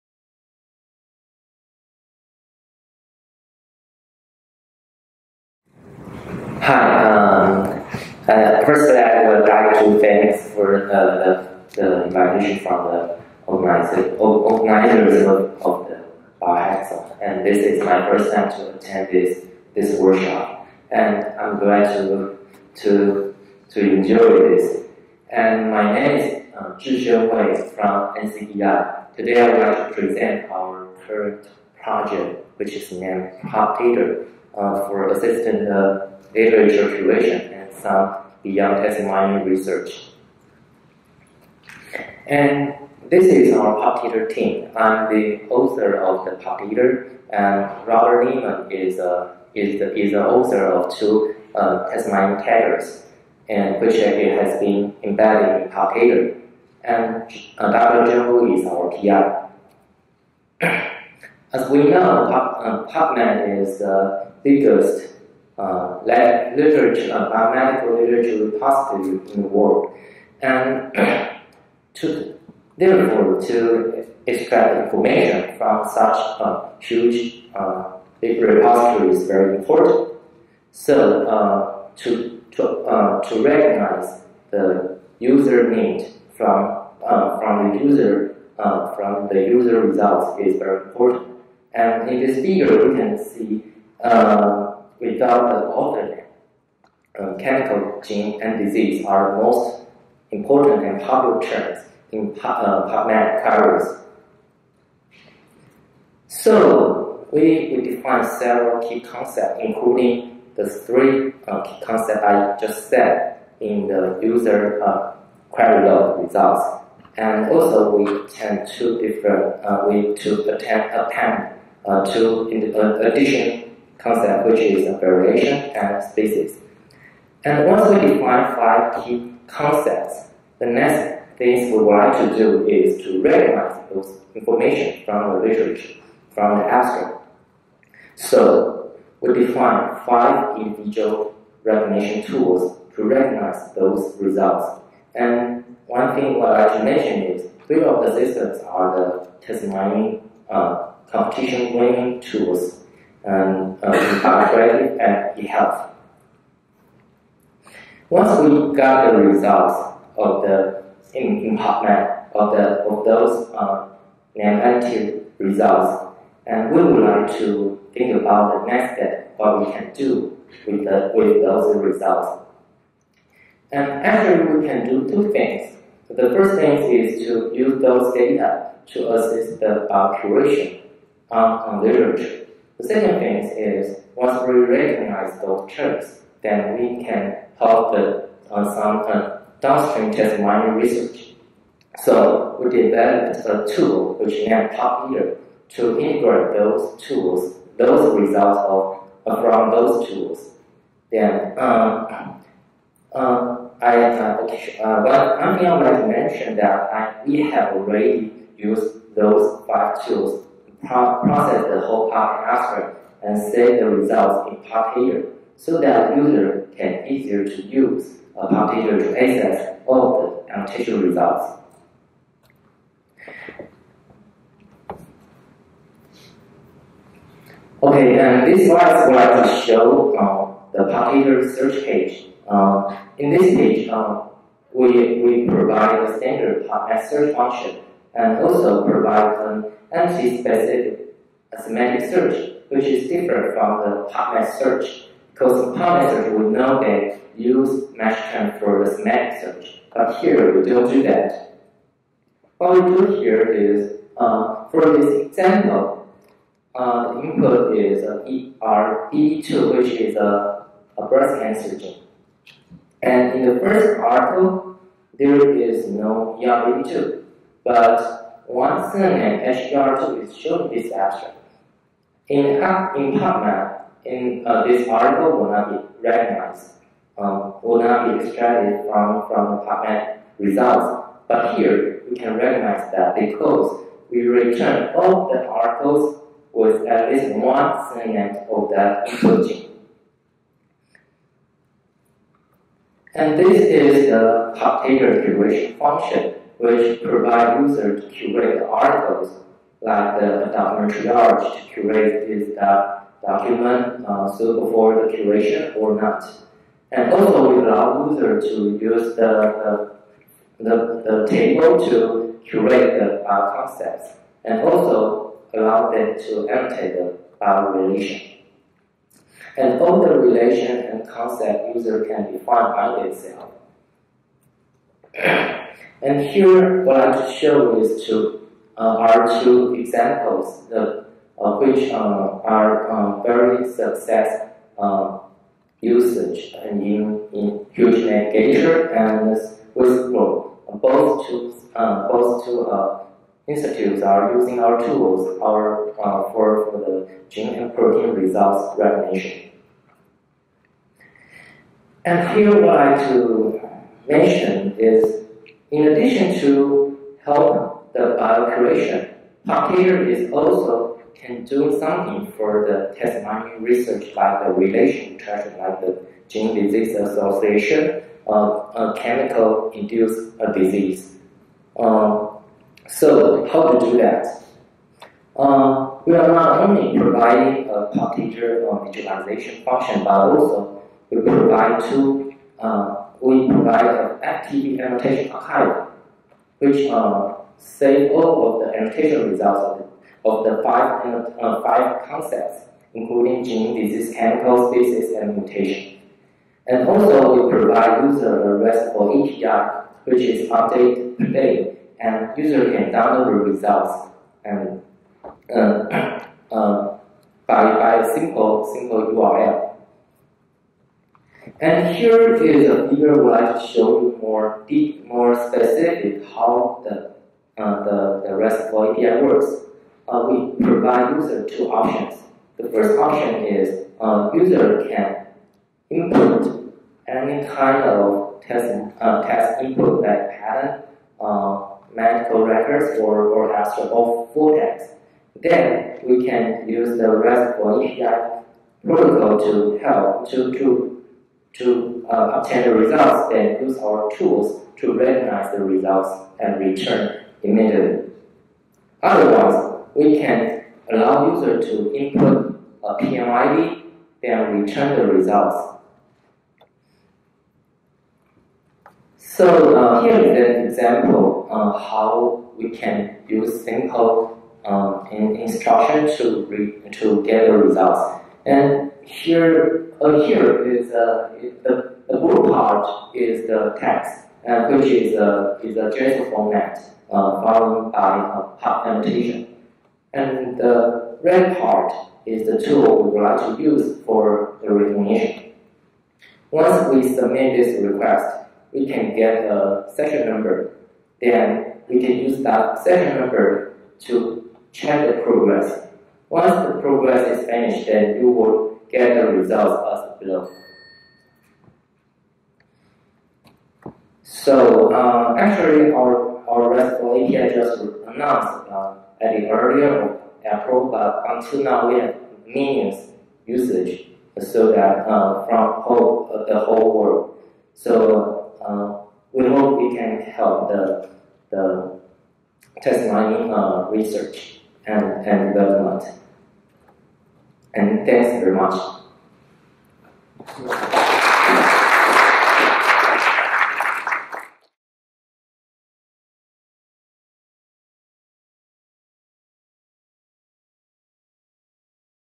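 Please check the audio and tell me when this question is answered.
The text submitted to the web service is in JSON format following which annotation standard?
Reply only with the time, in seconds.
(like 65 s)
478 s.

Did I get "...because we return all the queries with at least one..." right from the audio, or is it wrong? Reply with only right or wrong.
wrong.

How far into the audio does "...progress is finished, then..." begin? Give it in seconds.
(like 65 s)
496 s.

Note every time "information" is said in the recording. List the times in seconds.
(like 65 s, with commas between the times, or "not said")
74 s, 134 s.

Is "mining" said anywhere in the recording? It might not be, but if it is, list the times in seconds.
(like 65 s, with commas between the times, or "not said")
190 s, 363 s, 523 s.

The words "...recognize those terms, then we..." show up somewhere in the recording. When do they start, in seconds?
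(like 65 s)
184 s.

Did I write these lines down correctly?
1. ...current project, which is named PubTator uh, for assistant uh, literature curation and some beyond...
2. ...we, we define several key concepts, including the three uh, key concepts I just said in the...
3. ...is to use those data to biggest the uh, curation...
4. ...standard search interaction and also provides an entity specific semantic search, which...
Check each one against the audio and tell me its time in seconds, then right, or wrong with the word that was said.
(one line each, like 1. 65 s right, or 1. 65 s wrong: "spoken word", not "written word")
1. 31 s right
2. 107 s right
3. 176 s wrong: "assist", not "biggest"
4. 236 s wrong: "function", not "interaction".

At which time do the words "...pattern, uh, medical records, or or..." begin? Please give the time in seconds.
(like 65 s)
430 s.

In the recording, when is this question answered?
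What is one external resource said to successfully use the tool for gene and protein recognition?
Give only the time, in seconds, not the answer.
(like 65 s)
337 s.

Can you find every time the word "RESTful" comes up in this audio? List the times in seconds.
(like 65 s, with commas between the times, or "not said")
398 s, 418 s, 437 s, 506 s.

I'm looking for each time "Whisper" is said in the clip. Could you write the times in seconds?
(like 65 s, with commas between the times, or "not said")
339 s.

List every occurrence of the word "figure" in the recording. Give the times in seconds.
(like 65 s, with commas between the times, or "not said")
92 s, 412 s.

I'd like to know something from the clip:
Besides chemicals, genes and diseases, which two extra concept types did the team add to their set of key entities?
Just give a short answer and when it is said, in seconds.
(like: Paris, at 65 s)
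variation and species, at 124 s.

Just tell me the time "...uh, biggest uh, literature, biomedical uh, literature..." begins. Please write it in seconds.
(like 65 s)
63 s.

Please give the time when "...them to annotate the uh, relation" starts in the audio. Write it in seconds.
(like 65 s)
315 s.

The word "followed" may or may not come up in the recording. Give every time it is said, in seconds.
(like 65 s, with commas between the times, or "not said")
477 s.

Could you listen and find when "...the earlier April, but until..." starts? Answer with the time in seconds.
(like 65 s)
509 s.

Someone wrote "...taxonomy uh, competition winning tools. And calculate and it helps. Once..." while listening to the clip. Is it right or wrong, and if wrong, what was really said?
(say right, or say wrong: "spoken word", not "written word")
right.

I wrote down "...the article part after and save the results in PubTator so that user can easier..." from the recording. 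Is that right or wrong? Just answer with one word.
wrong.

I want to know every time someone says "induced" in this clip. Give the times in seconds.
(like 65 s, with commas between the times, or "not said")
369 s.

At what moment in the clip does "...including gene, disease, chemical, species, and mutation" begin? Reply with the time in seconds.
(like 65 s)
392 s.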